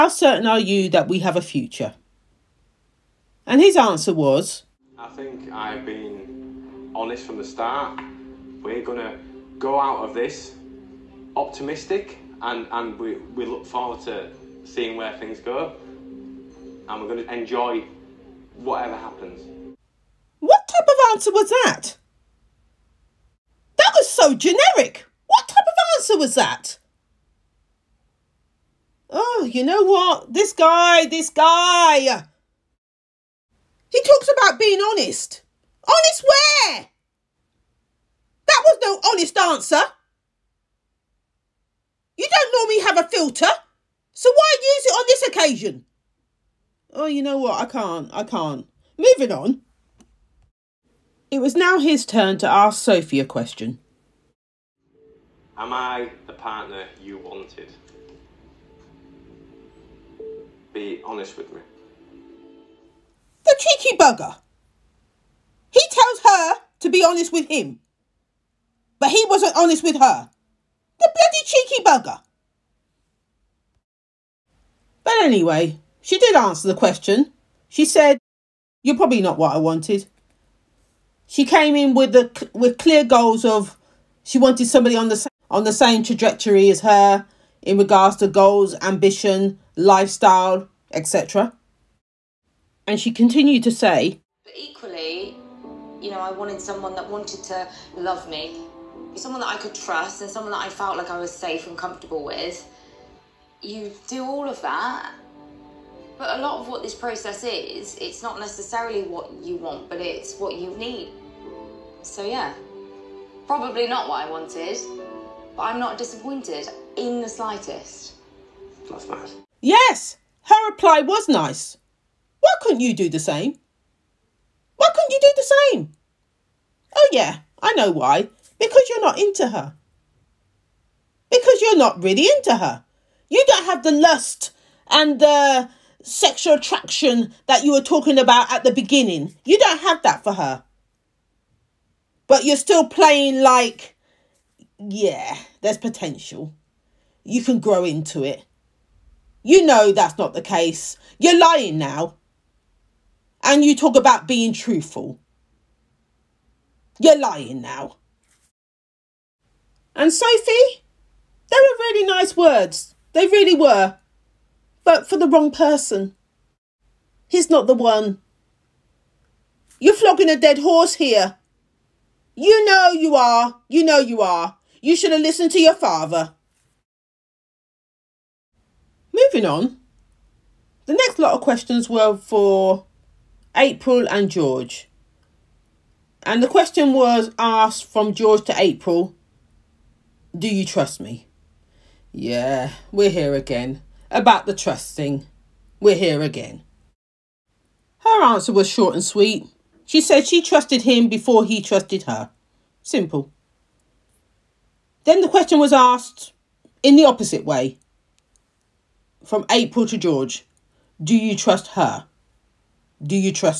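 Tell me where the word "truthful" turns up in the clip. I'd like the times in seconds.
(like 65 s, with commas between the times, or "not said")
154 s.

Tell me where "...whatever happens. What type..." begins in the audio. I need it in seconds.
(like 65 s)
18 s.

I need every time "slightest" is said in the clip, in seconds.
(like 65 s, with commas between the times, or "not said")
117 s.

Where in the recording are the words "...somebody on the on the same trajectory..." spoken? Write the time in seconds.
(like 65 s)
84 s.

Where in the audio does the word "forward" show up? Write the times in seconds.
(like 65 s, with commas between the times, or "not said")
13 s.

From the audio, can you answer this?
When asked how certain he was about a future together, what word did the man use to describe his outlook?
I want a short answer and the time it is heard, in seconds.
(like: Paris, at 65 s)
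optimistic, at 11 s.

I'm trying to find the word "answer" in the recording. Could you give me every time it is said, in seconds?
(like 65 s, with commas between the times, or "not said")
3 s, 21 s, 25 s, 39 s, 76 s, 198 s.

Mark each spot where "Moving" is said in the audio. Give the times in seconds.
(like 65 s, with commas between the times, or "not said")
48 s, 179 s.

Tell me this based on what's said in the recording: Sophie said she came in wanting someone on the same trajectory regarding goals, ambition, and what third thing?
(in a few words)
lifestyle.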